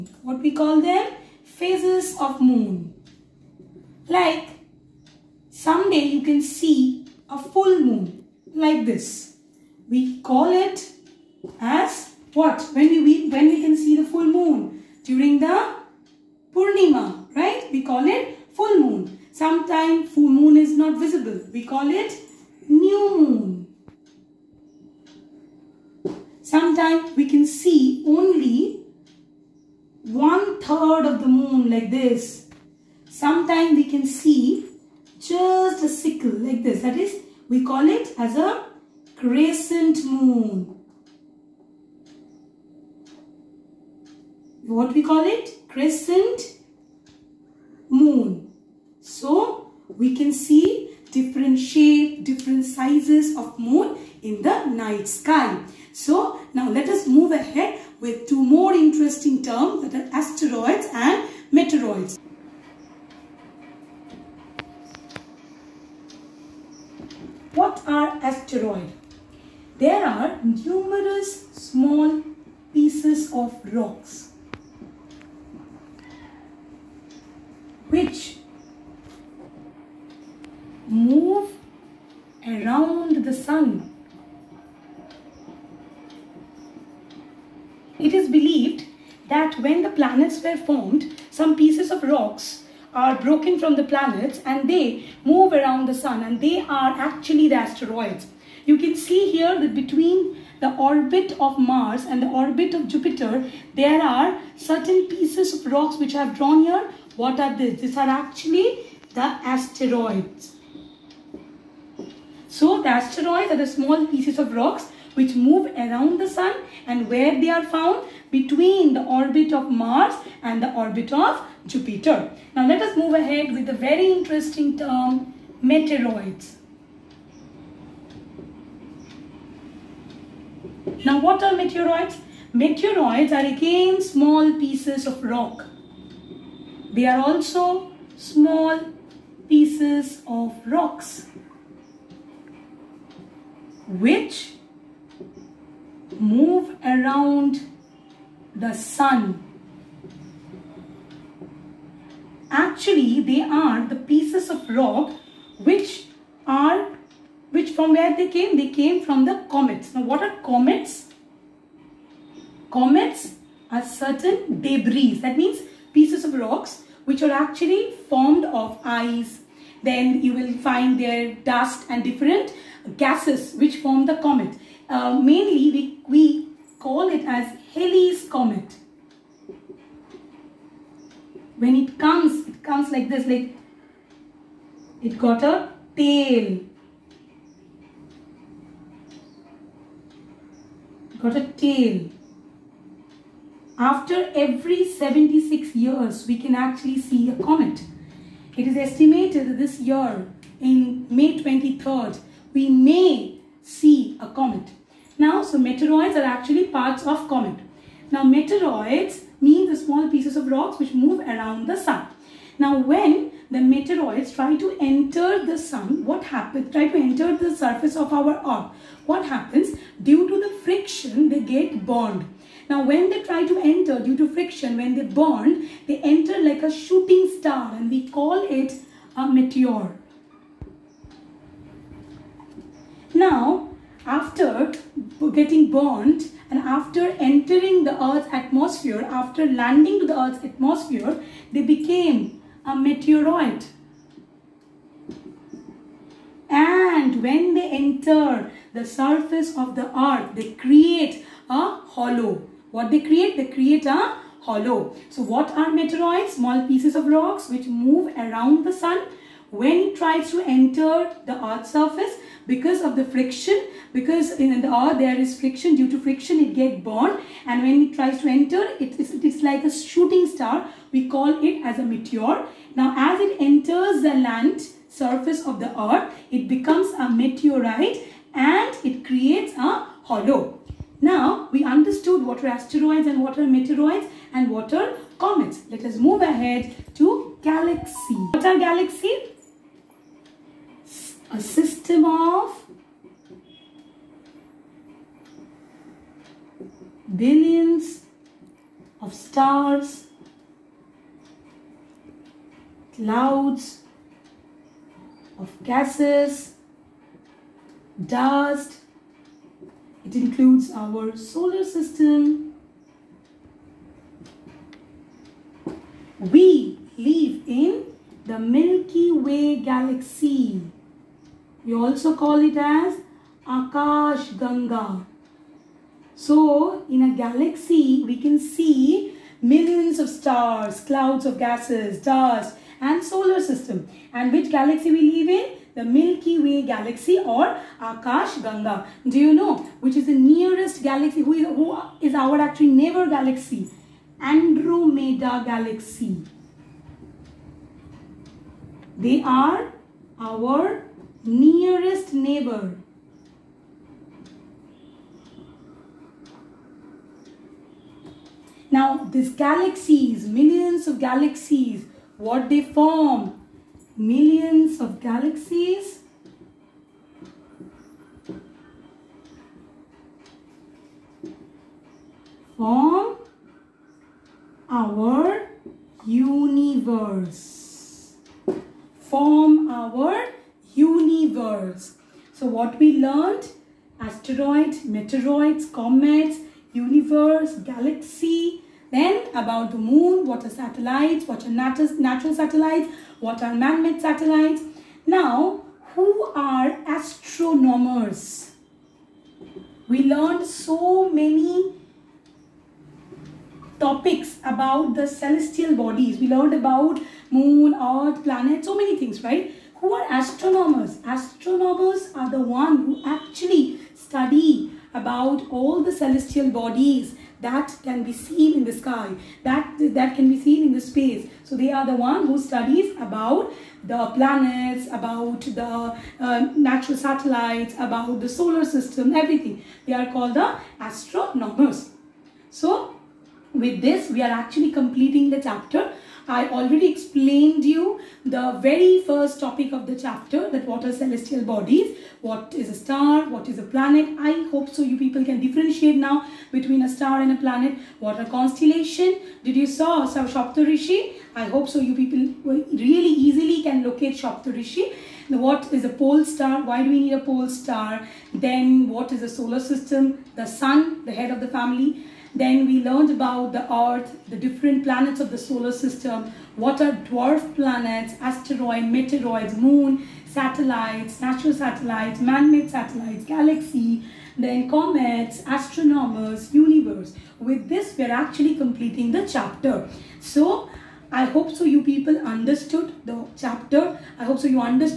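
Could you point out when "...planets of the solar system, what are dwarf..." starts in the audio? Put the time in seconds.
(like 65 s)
464 s.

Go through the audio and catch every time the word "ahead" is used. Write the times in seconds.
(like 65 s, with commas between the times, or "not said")
57 s, 123 s, 286 s.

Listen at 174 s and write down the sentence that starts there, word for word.
Uh, mainly we, we call it as Halley's Comet.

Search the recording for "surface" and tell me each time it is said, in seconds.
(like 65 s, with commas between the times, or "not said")
217 s, 248 s, 261 s, 274 s.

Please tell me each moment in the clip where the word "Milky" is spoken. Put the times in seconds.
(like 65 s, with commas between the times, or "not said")
318 s, 335 s.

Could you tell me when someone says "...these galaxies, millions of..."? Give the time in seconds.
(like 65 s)
359 s.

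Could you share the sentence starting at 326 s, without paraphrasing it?
So, in a galaxy, we can see millions of stars, clouds of gases, dust and solar system.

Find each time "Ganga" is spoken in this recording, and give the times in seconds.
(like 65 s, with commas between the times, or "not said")
324 s, 338 s.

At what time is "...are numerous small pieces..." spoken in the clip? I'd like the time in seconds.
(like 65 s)
70 s.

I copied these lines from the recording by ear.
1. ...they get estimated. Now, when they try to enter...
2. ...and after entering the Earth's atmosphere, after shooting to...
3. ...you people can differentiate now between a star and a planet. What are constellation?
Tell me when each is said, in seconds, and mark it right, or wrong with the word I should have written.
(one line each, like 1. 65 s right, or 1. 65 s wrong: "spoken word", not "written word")
1. 221 s wrong: "burned", not "estimated"
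2. 236 s wrong: "landing", not "shooting"
3. 444 s right.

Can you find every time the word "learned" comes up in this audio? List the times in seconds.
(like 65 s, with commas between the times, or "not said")
382 s, 400 s, 406 s, 462 s.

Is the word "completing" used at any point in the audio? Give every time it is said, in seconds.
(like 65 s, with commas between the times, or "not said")
434 s, 478 s.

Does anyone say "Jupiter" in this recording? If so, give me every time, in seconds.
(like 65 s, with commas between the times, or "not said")
102 s, 121 s.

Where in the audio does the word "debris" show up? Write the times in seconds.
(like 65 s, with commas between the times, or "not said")
164 s.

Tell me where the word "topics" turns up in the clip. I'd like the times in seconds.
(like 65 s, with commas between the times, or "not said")
403 s, 439 s.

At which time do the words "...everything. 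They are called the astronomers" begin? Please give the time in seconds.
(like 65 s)
429 s.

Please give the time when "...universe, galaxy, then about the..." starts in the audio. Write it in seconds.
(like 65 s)
386 s.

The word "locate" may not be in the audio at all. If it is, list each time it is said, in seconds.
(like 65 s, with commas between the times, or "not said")
453 s.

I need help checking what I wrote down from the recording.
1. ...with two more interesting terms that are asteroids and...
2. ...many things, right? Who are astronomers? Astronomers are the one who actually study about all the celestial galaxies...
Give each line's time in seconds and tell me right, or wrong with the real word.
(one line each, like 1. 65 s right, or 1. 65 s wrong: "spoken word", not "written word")
1. 58 s right
2. 408 s wrong: "bodies", not "galaxies".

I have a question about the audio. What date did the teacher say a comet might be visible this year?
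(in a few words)
May 23rd.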